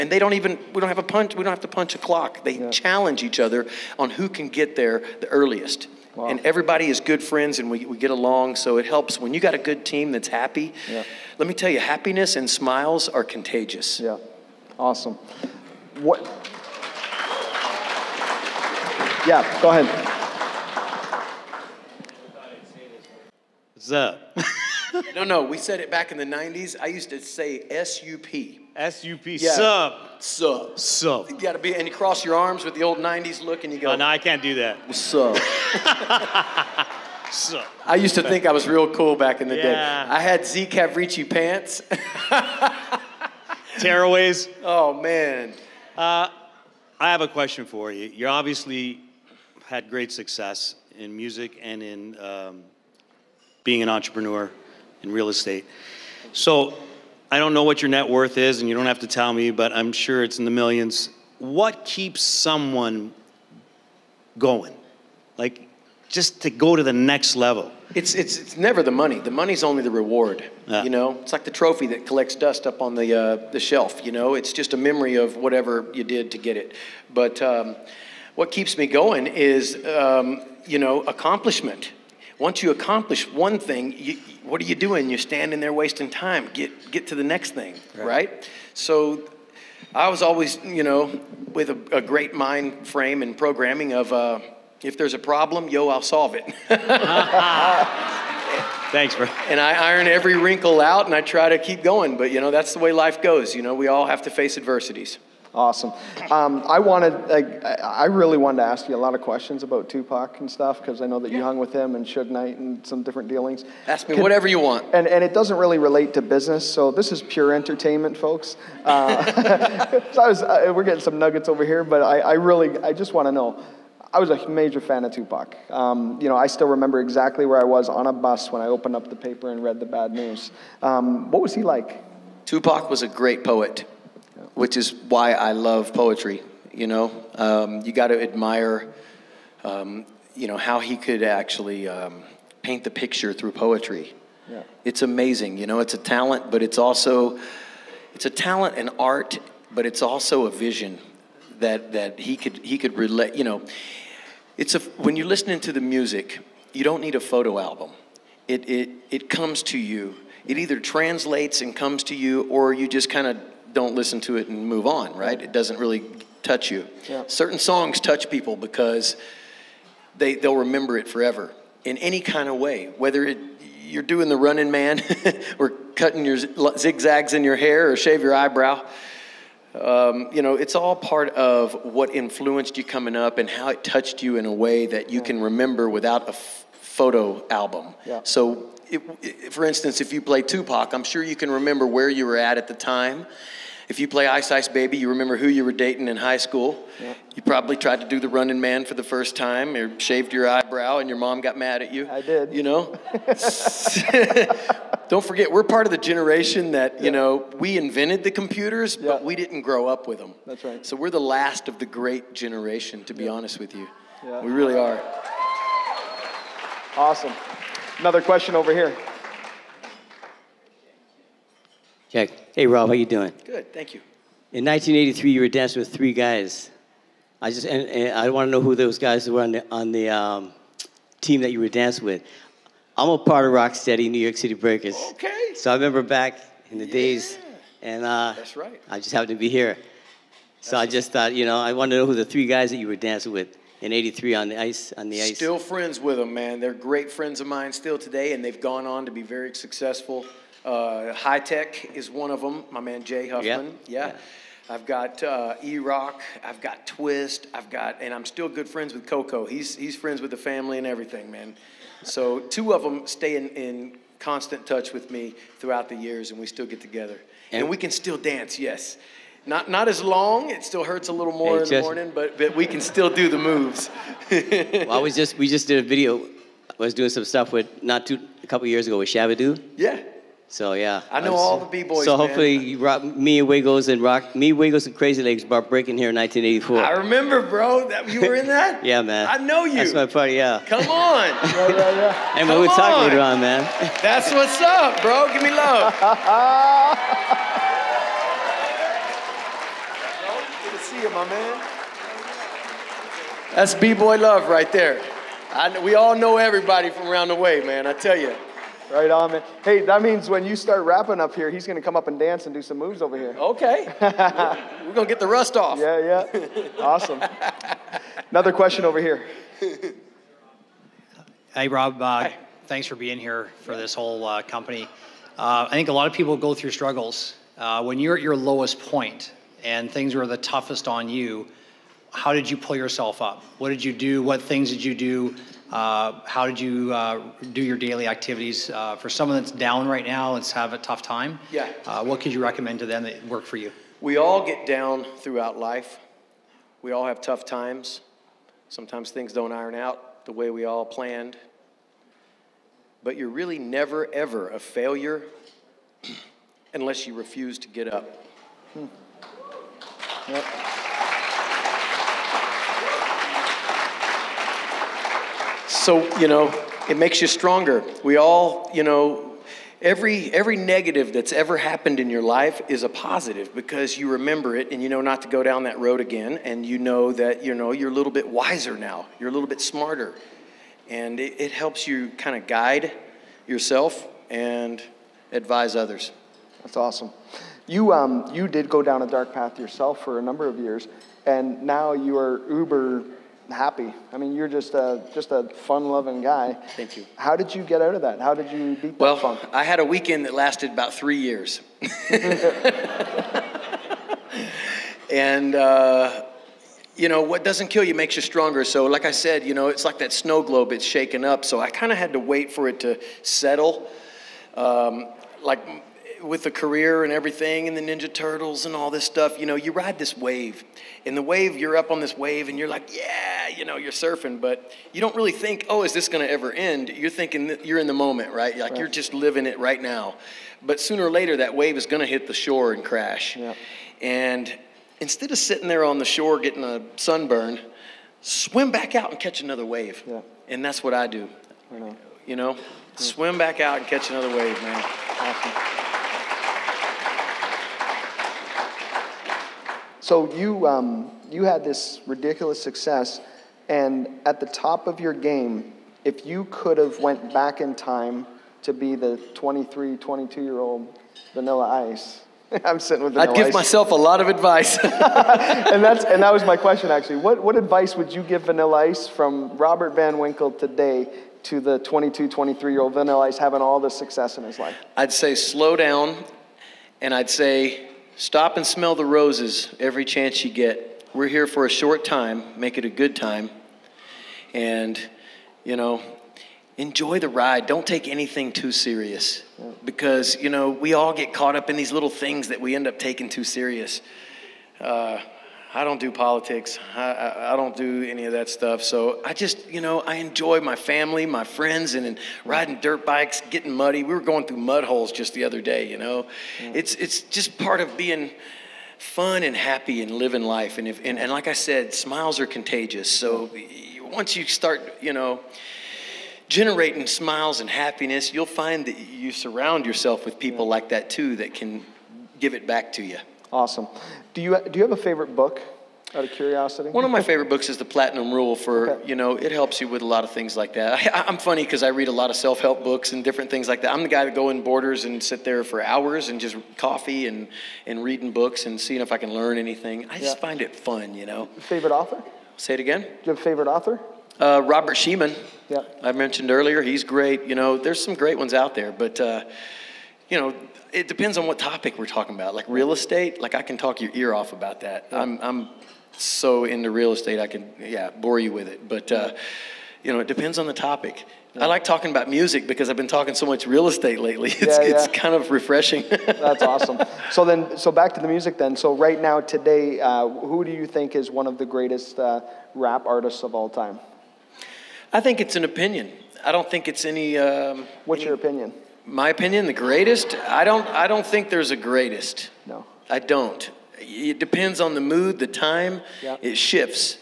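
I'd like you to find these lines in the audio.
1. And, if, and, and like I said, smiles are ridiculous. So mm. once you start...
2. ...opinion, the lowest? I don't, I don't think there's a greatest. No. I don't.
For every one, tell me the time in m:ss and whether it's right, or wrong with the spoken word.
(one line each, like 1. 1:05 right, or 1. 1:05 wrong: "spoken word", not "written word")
1. 8:30 wrong: "contagious", not "ridiculous"
2. 9:39 wrong: "greatest", not "lowest".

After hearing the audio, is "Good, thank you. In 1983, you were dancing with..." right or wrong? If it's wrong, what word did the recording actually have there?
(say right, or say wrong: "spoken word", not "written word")
right.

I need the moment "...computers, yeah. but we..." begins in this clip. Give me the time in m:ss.
3:28.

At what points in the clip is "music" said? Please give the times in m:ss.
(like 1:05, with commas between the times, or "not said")
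0:51, 2:35, 9:22, 9:28.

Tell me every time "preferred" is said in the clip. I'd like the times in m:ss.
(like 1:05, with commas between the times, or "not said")
not said.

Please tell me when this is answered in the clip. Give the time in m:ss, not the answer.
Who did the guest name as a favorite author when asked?
9:04.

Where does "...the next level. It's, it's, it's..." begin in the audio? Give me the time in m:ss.
1:06.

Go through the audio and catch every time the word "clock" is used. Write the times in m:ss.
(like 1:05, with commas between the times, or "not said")
0:01.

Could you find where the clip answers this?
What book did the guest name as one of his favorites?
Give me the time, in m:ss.
8:47.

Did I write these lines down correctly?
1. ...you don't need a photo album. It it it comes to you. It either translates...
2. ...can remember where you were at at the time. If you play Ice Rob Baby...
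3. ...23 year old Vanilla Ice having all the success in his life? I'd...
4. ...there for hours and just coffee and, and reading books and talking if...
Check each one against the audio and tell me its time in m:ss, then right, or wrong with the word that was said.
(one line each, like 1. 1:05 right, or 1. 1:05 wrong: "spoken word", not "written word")
1. 2:36 right
2. 3:11 wrong: "Ice", not "Rob"
3. 7:52 right
4. 8:55 wrong: "seeing", not "talking".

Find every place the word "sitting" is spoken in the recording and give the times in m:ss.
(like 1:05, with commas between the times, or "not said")
7:15, 7:42.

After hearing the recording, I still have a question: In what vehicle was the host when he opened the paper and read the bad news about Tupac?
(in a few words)
A bus.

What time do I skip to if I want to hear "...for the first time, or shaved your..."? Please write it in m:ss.
3:18.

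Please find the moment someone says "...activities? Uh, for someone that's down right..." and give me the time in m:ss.
5:38.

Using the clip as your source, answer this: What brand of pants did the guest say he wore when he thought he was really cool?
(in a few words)
Z Cavaricci.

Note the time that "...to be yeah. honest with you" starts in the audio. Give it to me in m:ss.
3:33.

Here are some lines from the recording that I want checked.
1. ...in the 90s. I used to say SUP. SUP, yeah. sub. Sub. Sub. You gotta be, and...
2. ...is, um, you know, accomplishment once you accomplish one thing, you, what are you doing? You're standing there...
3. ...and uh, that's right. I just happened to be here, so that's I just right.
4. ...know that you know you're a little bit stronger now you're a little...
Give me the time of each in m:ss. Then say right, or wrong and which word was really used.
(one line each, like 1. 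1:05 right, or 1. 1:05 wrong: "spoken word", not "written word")
1. 0:26 right
2. 1:19 right
3. 3:57 right
4. 6:16 wrong: "wiser", not "stronger".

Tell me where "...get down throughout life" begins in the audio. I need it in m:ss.
5:44.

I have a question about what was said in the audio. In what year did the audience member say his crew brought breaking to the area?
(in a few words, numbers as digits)
1984.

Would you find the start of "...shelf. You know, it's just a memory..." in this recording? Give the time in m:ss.
1:13.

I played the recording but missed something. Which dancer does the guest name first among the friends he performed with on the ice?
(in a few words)
High Tech.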